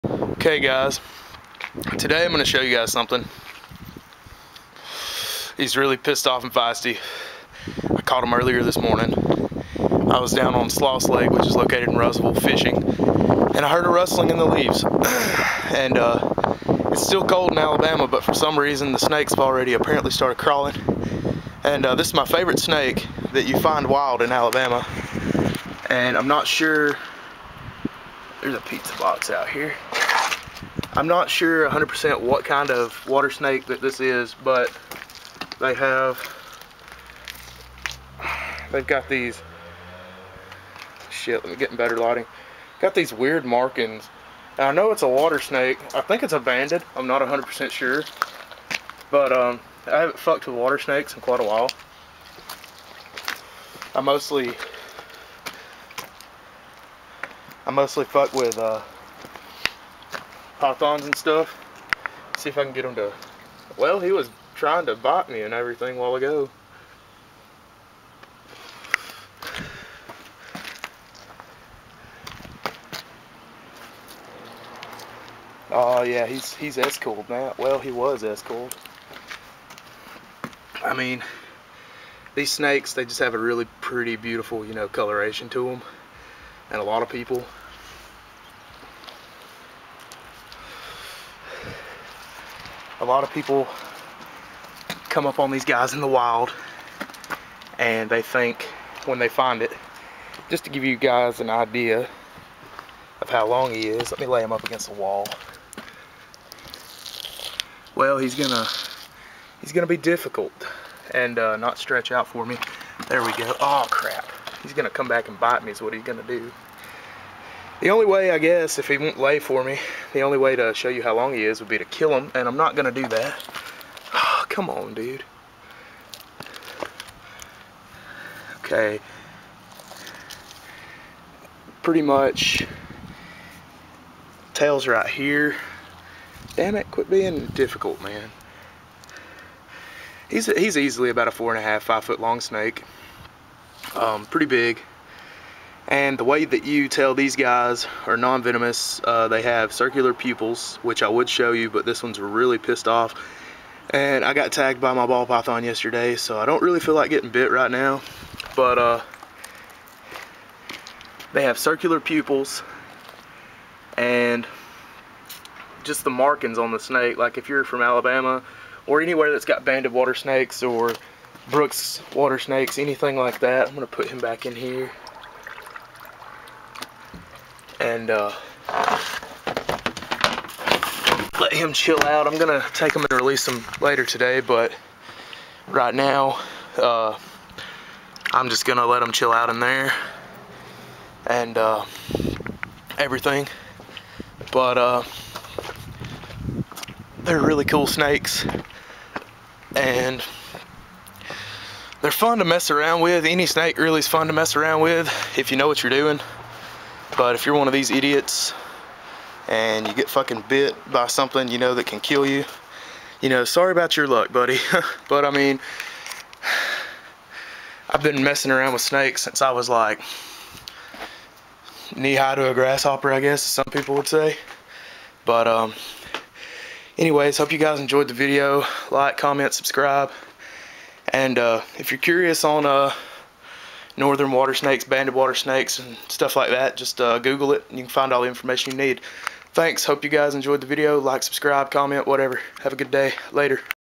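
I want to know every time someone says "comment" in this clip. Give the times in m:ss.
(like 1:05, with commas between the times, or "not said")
3:49, 4:01.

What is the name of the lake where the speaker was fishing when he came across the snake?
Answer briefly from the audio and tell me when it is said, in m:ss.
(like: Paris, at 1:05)
Sloss Lake, at 0:10.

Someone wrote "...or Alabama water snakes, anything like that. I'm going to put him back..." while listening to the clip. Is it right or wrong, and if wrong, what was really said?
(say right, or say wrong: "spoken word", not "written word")
wrong: "Brooks", not "Alabama".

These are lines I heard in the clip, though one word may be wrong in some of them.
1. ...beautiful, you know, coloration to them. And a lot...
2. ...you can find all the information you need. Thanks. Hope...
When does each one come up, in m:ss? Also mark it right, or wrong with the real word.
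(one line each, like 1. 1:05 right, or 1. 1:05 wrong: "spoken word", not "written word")
1. 1:24 right
2. 3:57 right.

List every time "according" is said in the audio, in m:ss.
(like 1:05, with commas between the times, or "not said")
not said.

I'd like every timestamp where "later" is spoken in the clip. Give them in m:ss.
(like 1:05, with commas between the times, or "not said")
3:03, 4:03.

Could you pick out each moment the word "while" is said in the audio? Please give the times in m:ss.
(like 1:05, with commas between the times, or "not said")
0:51, 1:05.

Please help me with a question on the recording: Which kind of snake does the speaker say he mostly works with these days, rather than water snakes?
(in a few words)
pythons.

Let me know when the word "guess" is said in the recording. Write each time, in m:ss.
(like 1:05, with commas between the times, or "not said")
1:58, 3:43.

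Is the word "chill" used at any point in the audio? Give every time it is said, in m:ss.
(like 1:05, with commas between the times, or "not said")
3:01, 3:09.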